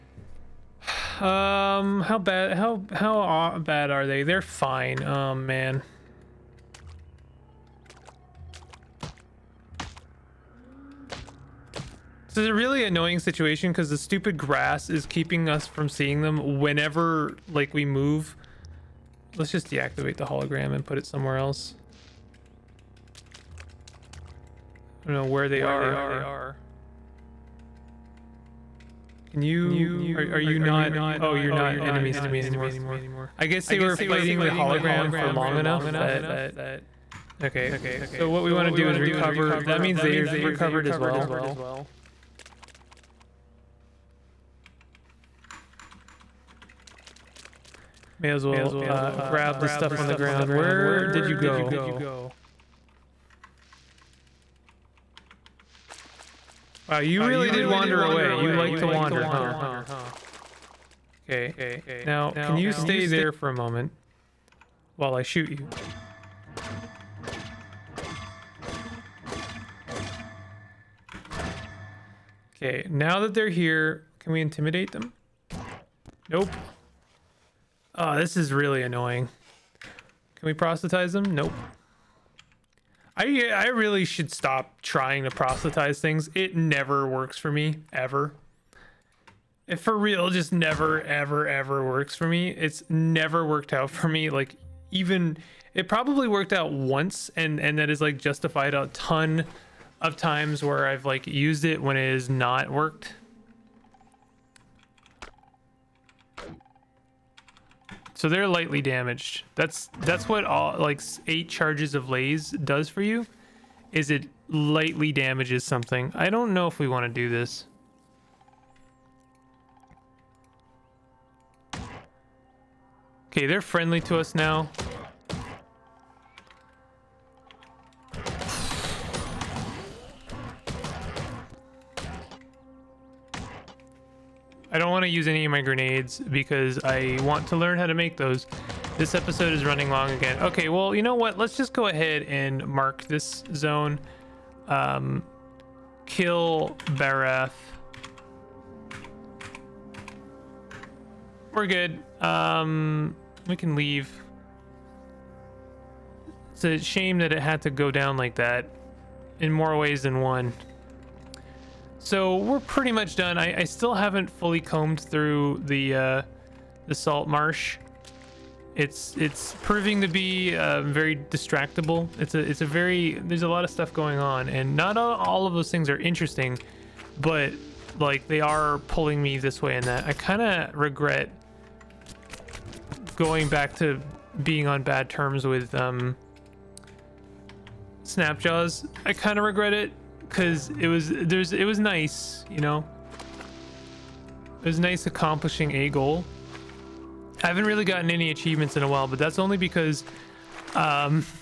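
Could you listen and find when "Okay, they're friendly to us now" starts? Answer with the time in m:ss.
2:03.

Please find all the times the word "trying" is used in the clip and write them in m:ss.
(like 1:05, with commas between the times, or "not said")
1:24.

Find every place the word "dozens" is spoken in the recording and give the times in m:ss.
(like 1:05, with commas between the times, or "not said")
not said.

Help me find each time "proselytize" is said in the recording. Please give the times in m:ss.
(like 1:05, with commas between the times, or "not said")
1:20, 1:25.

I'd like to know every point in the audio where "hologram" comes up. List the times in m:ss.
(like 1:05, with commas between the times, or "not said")
0:20, 0:34.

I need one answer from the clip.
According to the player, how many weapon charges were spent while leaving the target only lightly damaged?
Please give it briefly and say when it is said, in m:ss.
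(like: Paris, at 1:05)
8, at 1:51.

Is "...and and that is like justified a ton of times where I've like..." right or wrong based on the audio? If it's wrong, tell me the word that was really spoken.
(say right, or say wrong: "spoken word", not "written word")
right.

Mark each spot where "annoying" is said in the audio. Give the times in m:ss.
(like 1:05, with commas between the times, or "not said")
0:12, 1:18.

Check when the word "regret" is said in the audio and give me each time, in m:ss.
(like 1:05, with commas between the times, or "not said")
3:00, 3:09.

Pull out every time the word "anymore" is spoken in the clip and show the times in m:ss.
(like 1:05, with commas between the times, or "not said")
0:32.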